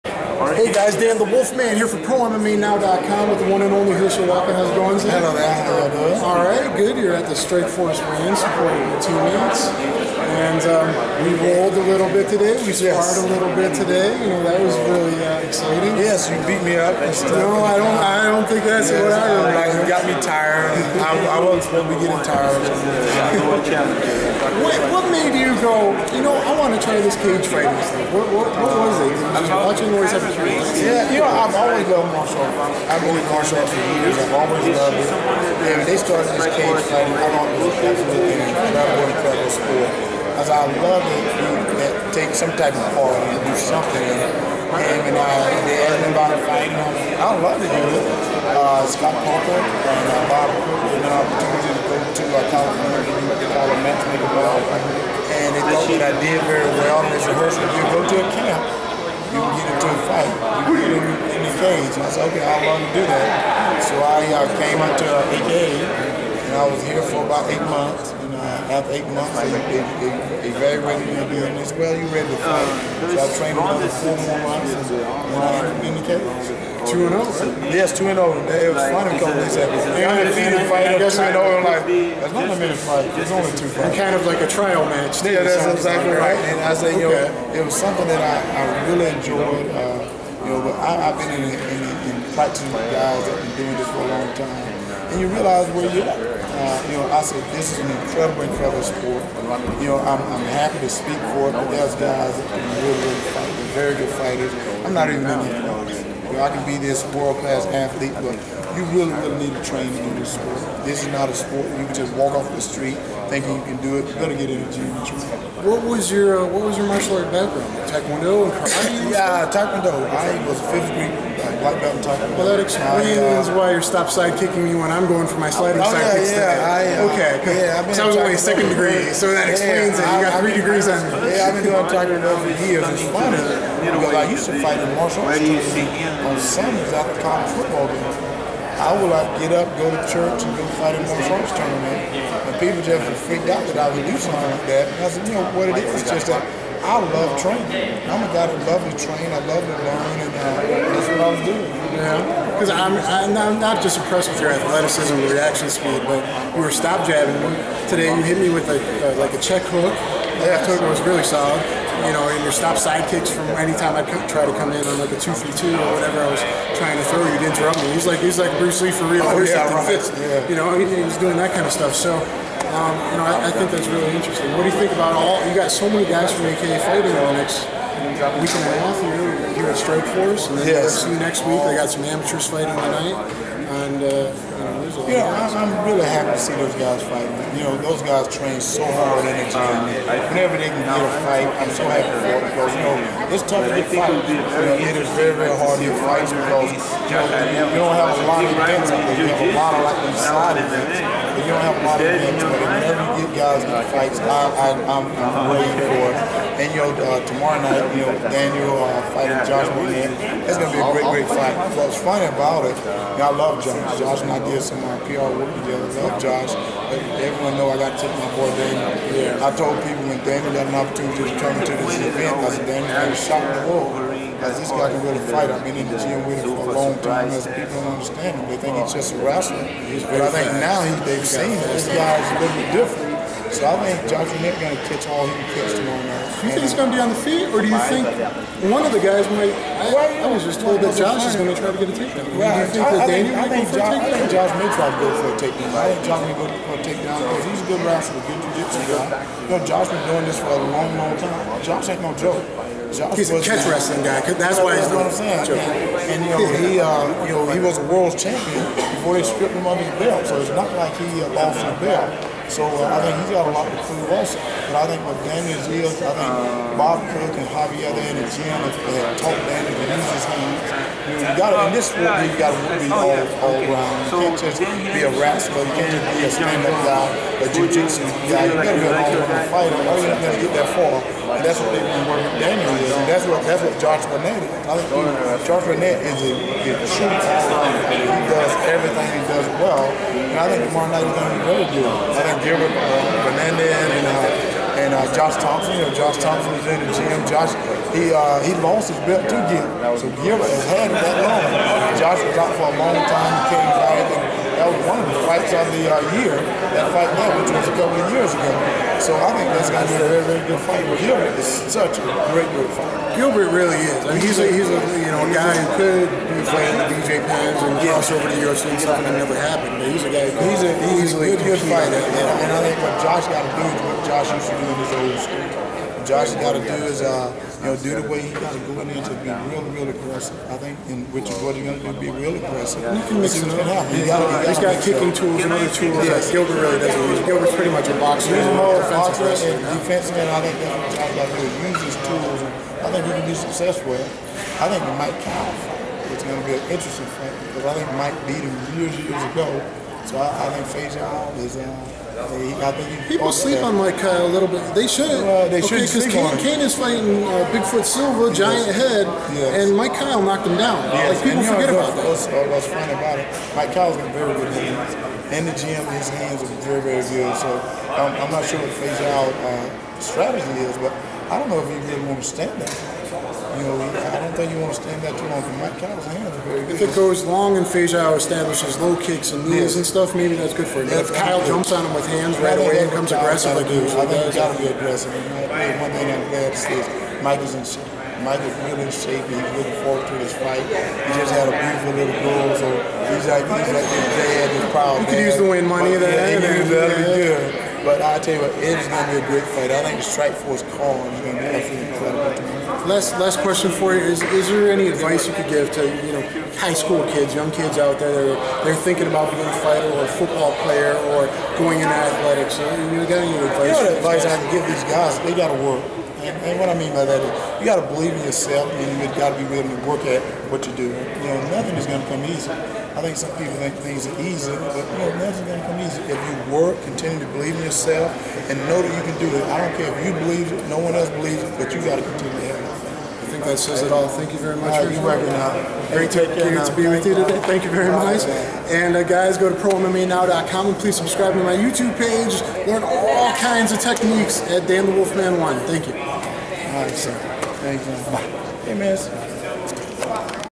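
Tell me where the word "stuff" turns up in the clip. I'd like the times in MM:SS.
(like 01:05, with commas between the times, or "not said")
00:17, 00:27, 02:51, 05:18, 06:19.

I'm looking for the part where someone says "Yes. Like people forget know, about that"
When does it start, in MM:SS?
06:00.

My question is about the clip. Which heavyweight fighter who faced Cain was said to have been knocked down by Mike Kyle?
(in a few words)
Bigfoot Silva.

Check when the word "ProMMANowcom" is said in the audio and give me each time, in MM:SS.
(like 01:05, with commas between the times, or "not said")
00:02, 07:19.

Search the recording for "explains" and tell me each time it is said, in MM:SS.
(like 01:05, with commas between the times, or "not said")
02:02, 02:09.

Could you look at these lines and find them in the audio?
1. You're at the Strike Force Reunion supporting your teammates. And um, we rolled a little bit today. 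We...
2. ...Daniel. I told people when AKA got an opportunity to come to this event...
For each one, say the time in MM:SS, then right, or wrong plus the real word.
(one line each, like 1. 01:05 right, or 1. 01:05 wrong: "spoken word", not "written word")
1. 00:06 right
2. 03:38 wrong: "Daniel", not "AKA".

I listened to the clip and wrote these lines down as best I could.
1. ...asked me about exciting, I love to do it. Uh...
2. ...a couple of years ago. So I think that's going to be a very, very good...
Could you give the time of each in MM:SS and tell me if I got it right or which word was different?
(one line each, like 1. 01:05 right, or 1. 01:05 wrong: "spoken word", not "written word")
1. 00:45 wrong: "fighting", not "exciting"
2. 05:07 right.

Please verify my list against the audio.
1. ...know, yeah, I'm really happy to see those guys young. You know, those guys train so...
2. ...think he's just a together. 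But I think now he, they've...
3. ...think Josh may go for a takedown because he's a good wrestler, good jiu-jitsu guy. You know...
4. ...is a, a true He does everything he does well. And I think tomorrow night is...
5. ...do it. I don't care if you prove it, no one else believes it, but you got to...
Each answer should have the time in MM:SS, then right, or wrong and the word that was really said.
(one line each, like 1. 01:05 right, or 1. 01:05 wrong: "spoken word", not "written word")
1. 03:04 wrong: "fighting", not "young"
2. 03:48 wrong: "wrestler", not "together"
3. 04:05 right
4. 04:46 right
5. 07:09 wrong: "believe", not "prove".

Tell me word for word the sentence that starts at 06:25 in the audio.
And one thing I'm glad to see is Mike is in shape.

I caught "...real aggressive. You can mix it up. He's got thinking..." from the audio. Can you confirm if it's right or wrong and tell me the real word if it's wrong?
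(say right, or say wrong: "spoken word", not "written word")
wrong: "kicking", not "thinking".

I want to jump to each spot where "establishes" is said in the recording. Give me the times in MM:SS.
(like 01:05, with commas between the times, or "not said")
06:18.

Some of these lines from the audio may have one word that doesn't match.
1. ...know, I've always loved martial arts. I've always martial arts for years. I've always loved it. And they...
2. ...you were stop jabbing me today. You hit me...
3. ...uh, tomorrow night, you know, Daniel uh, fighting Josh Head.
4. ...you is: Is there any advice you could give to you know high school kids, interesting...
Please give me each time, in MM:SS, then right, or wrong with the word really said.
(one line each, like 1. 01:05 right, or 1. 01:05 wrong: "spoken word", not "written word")
1. 00:31 right
2. 02:36 right
3. 03:26 wrong: "Barnett", not "Head"
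4. 06:43 wrong: "young", not "interesting".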